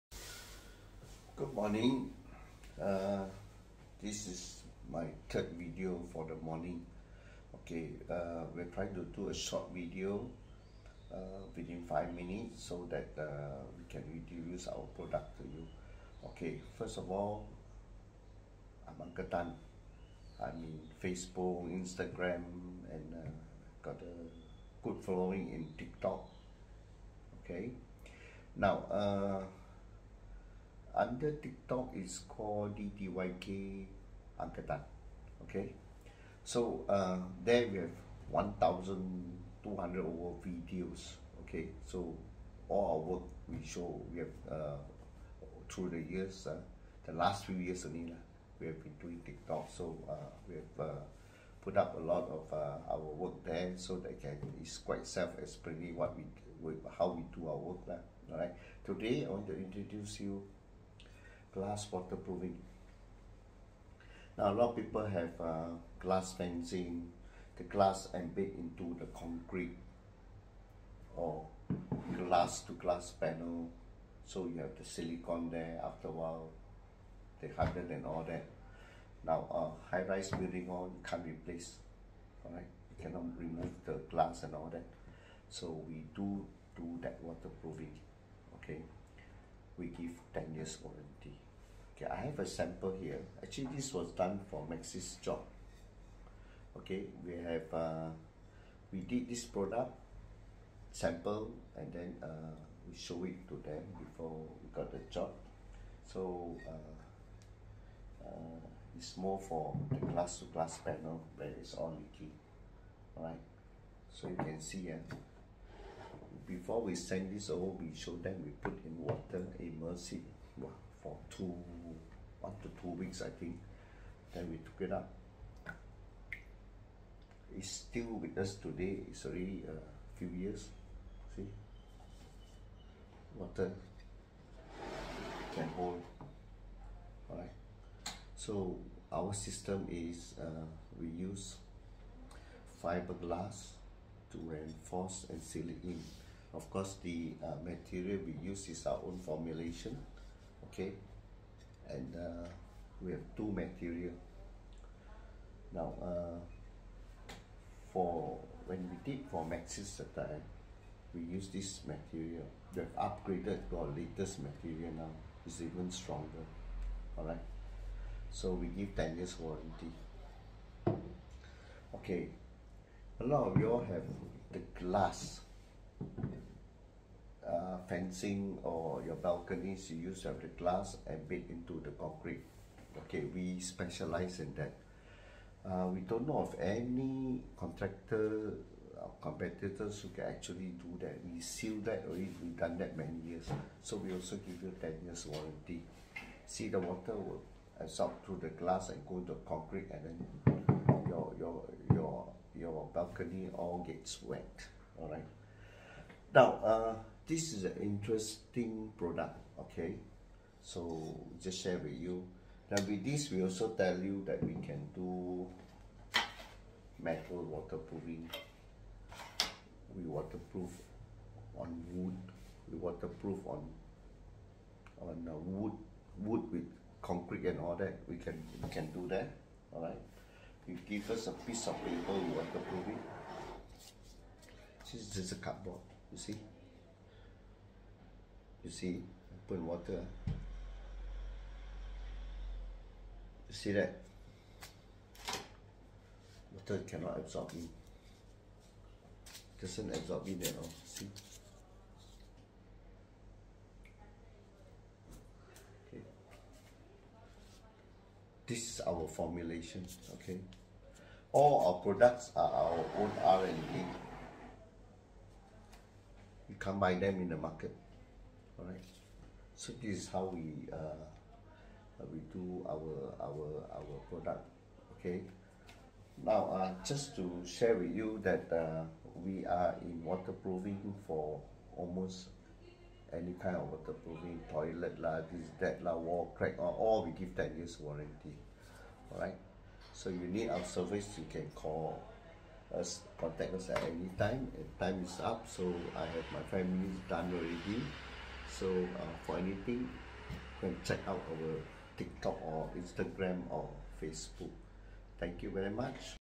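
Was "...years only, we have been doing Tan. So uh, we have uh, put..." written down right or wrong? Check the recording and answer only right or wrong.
wrong.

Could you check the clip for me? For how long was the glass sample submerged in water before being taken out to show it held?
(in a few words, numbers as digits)
2 weeks.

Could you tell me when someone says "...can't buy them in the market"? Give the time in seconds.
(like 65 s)
266 s.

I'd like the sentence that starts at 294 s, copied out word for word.
Time is up, so I have my family done already.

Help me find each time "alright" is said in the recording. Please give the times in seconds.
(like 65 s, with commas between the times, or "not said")
82 s, 113 s, 137 s, 205 s, 289 s.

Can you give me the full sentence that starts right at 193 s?
So we also give you 10 years warranty.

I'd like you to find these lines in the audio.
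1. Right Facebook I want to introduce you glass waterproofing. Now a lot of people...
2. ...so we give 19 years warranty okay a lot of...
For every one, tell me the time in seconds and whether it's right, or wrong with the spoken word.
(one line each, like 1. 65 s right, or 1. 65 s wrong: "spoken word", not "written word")
1. 58 s wrong: "Today", not "Facebook"
2. 168 s wrong: "10", not "19".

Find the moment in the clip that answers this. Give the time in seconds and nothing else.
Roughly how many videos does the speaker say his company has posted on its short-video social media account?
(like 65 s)
38 s.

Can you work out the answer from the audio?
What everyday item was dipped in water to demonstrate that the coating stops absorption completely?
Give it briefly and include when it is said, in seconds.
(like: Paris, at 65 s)
cardboard, at 235 s.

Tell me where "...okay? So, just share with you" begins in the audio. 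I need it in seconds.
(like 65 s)
209 s.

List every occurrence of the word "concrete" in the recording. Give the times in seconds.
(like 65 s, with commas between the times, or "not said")
69 s, 181 s, 199 s, 227 s.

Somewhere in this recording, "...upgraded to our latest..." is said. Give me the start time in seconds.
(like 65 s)
162 s.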